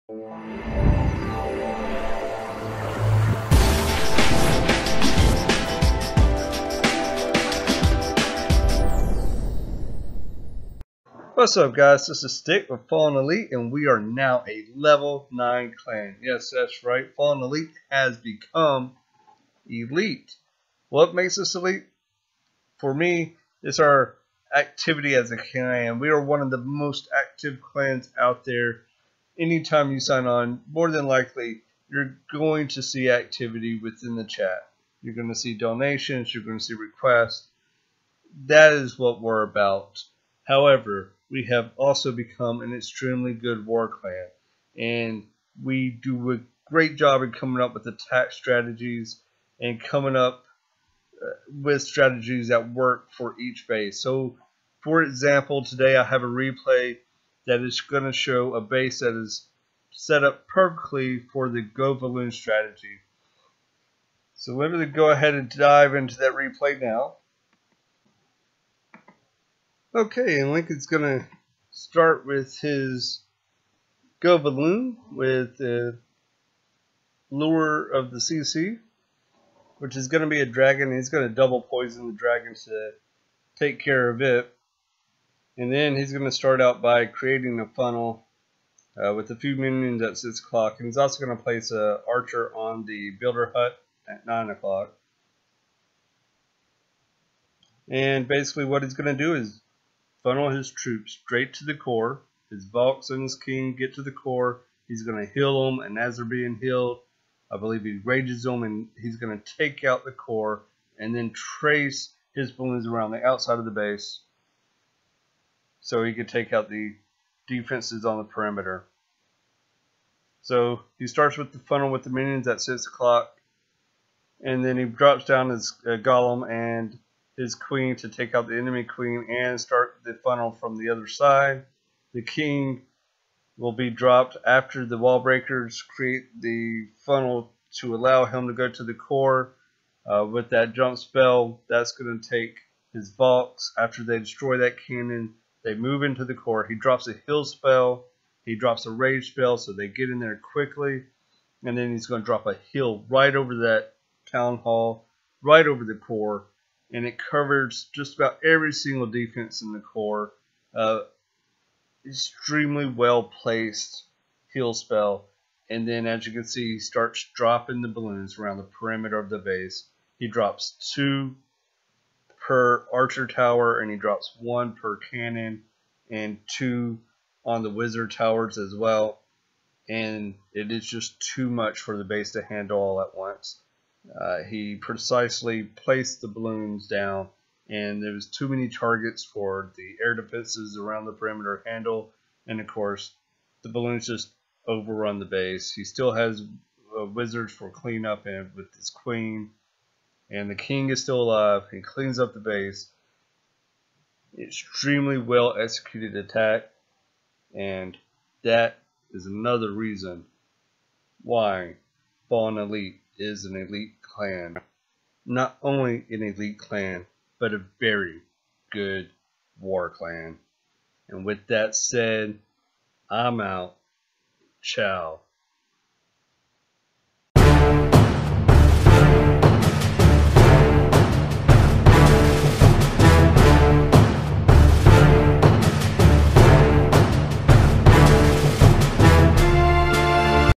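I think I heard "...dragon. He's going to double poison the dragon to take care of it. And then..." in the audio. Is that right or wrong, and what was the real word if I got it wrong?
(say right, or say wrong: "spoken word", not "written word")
right.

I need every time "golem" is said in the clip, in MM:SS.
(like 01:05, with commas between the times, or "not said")
02:05.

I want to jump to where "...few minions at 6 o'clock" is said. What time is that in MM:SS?
01:29.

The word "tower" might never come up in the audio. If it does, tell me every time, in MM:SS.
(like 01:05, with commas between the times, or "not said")
02:53, 02:58.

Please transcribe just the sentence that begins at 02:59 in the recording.
And it is just too much for the base to handle all at once.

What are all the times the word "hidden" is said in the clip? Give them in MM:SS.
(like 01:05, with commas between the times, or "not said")
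not said.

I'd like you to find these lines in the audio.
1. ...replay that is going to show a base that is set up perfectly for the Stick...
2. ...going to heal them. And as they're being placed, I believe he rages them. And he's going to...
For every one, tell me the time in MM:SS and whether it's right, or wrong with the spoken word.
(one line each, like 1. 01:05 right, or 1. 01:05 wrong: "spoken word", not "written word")
1. 00:56 wrong: "GoValoon", not "Stick"
2. 01:45 wrong: "healed", not "placed".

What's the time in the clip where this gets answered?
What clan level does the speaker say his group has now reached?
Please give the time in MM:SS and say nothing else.
00:14.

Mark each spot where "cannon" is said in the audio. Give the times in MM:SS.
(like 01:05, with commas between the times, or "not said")
02:24, 02:54.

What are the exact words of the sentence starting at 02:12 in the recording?
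The king will be dropped after the wall breakers create the funnel to allow him to go to the core.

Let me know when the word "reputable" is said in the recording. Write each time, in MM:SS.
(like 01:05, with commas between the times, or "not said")
not said.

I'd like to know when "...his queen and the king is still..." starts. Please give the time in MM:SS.
03:18.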